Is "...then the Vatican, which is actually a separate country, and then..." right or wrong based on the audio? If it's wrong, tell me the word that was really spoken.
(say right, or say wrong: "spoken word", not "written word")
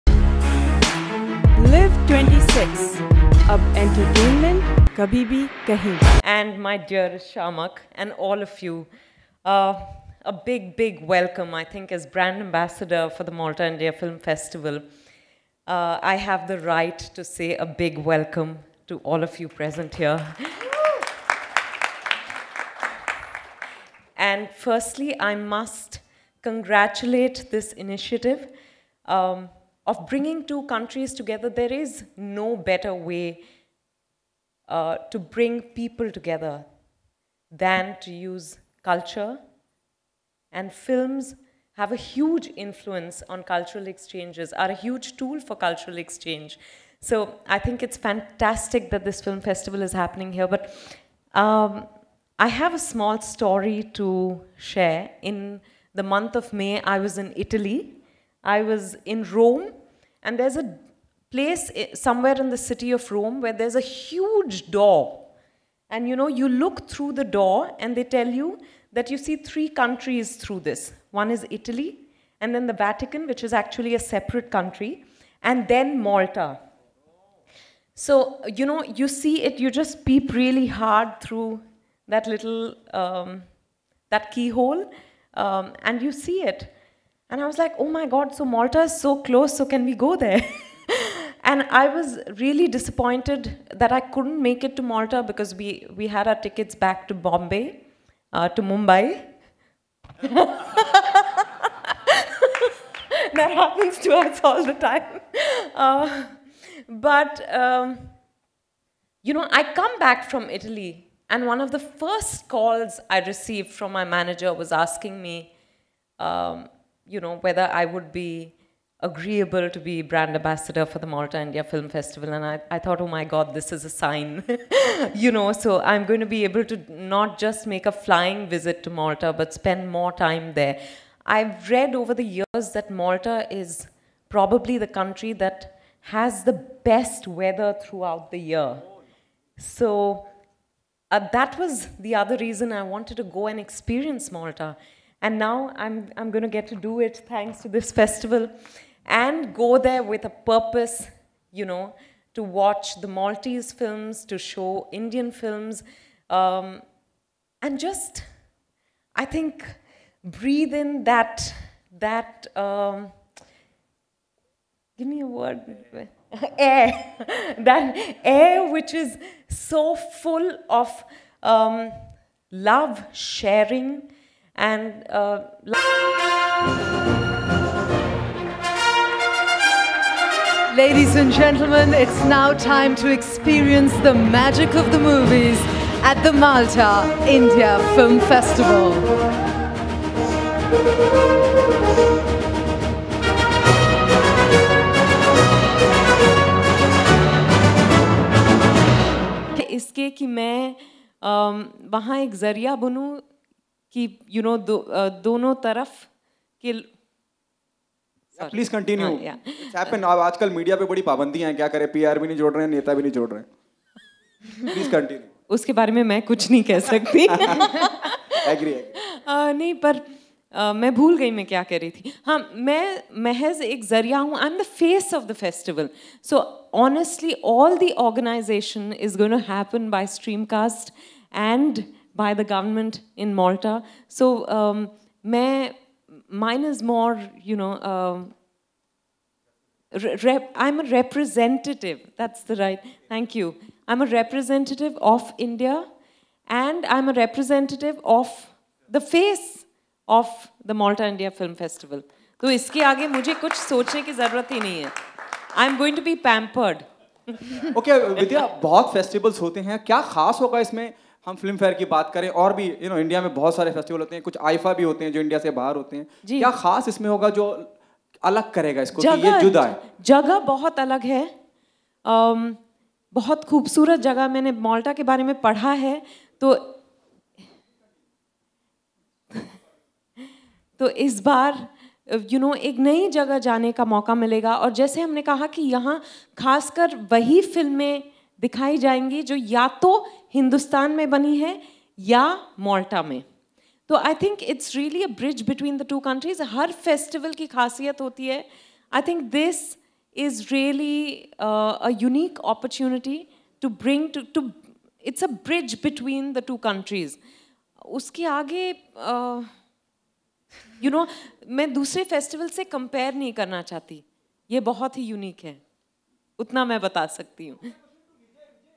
right.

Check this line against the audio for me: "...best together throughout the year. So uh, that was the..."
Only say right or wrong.
wrong.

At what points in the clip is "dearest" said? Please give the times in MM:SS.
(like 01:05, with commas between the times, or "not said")
00:06.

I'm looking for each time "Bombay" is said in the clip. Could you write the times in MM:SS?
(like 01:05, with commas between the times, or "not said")
01:37.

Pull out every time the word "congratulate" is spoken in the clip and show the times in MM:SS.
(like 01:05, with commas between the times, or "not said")
00:26.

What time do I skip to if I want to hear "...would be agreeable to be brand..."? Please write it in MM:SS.
01:57.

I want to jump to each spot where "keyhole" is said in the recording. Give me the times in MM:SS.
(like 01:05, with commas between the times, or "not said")
01:24.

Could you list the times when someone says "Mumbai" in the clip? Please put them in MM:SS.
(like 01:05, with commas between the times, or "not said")
01:38.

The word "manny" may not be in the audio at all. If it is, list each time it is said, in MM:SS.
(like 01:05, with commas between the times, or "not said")
not said.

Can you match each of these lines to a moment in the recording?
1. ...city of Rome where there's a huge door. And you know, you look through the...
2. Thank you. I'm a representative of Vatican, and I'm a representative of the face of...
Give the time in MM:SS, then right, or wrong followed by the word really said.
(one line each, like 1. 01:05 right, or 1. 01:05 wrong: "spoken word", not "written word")
1. 01:02 right
2. 04:03 wrong: "India", not "Vatican".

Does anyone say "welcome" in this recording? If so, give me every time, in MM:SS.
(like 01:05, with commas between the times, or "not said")
00:11, 00:18.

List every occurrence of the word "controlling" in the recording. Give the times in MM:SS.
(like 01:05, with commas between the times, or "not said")
not said.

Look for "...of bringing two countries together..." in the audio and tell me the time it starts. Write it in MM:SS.
00:29.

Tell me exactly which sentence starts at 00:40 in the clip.
And films have a huge influence on cultural exchanges, are a huge tool for cultural exchange.